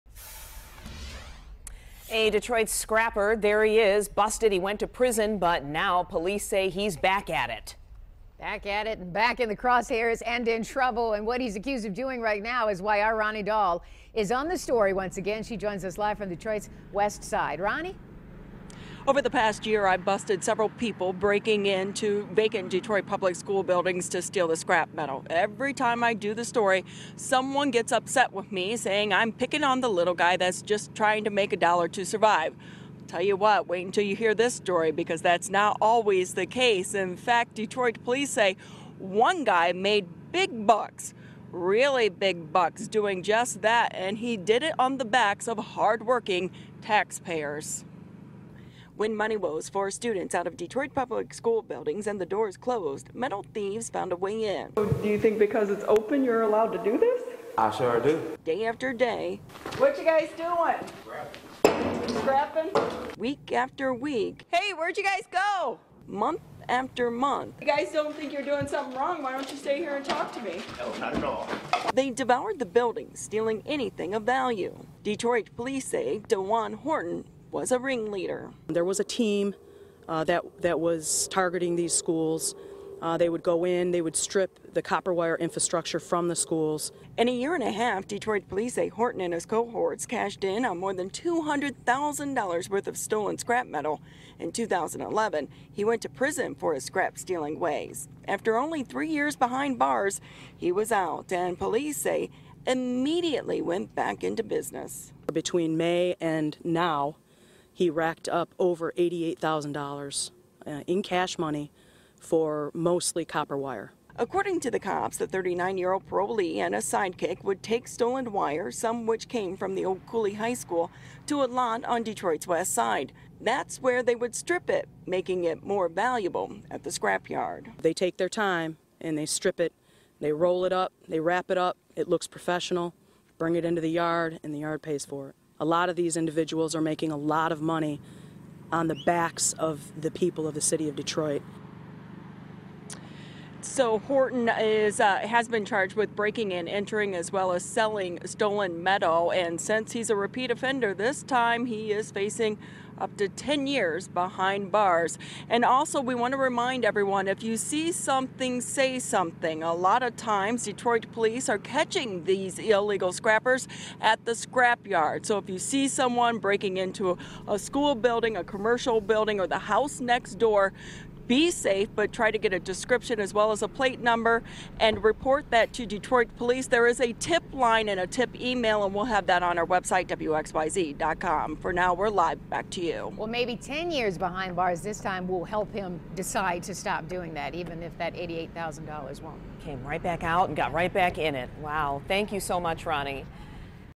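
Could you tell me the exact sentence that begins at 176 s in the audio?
There is a tip line and a tip email, and we'll have that on our website, WXYZ.com.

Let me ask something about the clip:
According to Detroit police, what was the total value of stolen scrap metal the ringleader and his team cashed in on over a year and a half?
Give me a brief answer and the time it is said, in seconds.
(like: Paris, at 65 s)
more than $200,000, at 90 s.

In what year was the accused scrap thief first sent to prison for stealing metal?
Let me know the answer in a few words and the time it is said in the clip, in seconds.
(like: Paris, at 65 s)
2011, at 94 s.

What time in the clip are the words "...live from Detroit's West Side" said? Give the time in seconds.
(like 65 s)
15 s.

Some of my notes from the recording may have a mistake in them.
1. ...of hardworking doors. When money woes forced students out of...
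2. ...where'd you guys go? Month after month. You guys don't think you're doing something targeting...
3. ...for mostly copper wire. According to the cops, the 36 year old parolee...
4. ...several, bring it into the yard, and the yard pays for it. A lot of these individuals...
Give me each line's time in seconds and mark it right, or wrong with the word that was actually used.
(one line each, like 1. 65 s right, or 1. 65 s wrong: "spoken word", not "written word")
1. 45 s wrong: "taxpayers", not "doors"
2. 64 s wrong: "wrong", not "targeting"
3. 112 s wrong: "39", not "36"
4. 132 s wrong: "professional", not "several".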